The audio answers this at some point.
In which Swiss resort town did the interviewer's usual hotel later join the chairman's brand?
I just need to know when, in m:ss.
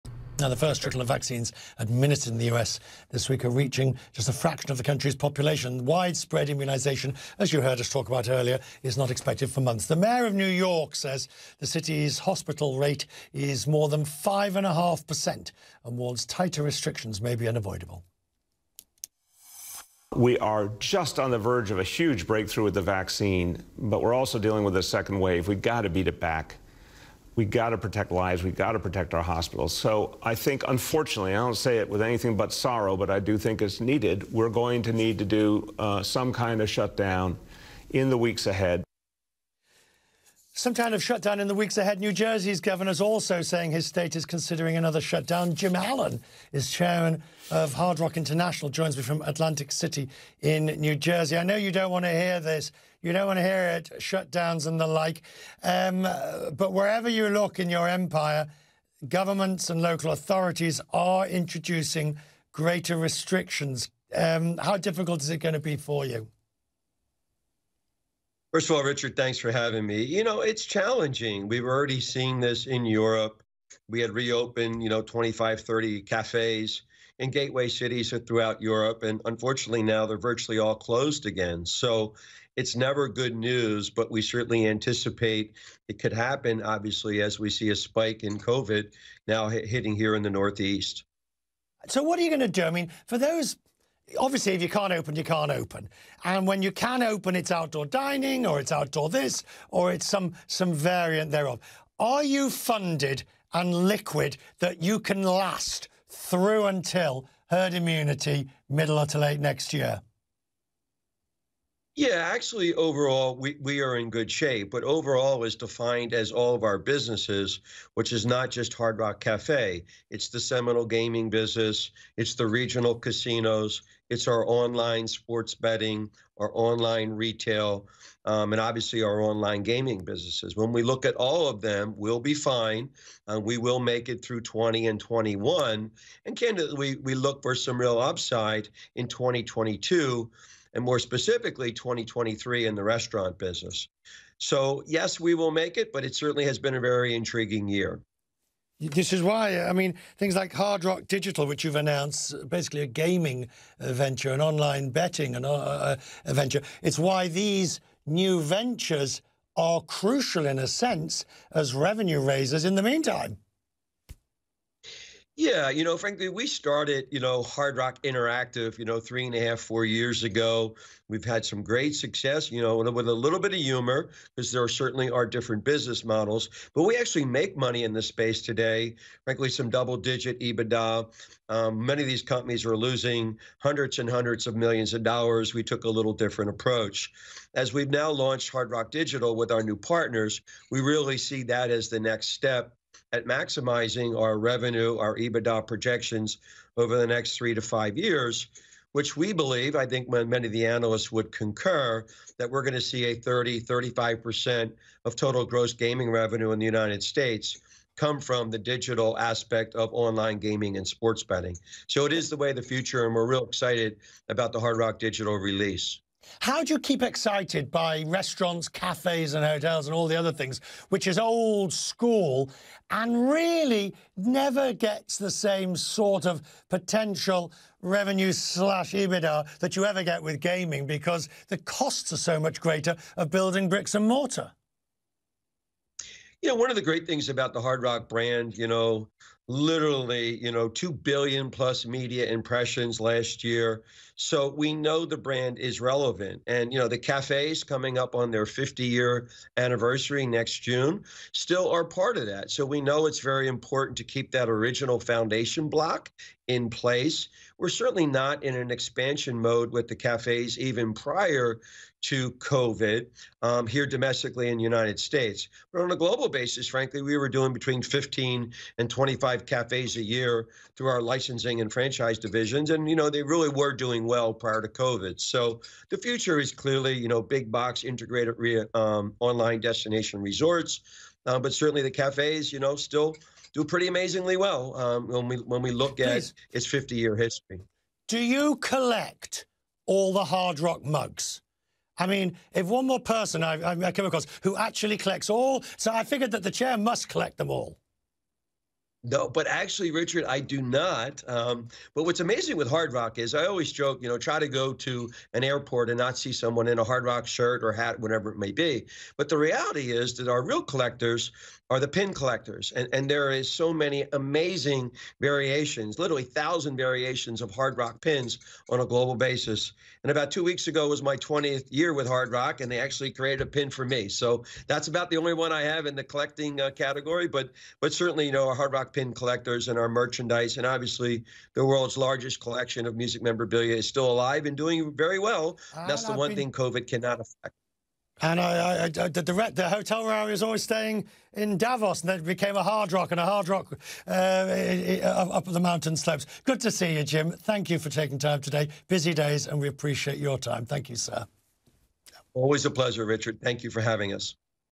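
5:41.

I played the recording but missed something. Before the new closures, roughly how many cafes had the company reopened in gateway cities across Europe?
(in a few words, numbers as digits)
25 to 30.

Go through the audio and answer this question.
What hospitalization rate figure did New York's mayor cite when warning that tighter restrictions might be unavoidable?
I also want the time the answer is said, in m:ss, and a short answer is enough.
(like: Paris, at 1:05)
5.5%, at 0:14.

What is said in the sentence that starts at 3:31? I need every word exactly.
So it is the way of the future, and we're real excited about the Hard Rock Digital release.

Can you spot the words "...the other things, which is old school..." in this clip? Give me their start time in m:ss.
3:40.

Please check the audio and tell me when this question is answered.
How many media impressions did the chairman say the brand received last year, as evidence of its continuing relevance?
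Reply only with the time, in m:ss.
4:00.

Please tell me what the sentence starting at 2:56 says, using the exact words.
But we actually make money in this space today.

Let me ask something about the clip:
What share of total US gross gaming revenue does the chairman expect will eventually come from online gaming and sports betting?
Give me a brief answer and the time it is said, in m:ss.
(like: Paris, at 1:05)
30 to 35%, at 3:23.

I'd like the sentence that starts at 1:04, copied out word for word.
Um, how difficult is it going to be for you?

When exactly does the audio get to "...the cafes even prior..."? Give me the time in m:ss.
4:19.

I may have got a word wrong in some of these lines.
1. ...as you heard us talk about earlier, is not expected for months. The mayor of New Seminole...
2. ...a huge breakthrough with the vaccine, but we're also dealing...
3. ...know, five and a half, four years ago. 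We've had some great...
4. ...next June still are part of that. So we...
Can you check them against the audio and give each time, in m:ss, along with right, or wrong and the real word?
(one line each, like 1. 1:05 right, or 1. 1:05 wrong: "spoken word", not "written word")
1. 0:07 wrong: "York", not "Seminole"
2. 0:21 right
3. 2:48 wrong: "three", not "five"
4. 4:10 right.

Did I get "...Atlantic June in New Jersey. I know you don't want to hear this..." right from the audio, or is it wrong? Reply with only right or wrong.
wrong.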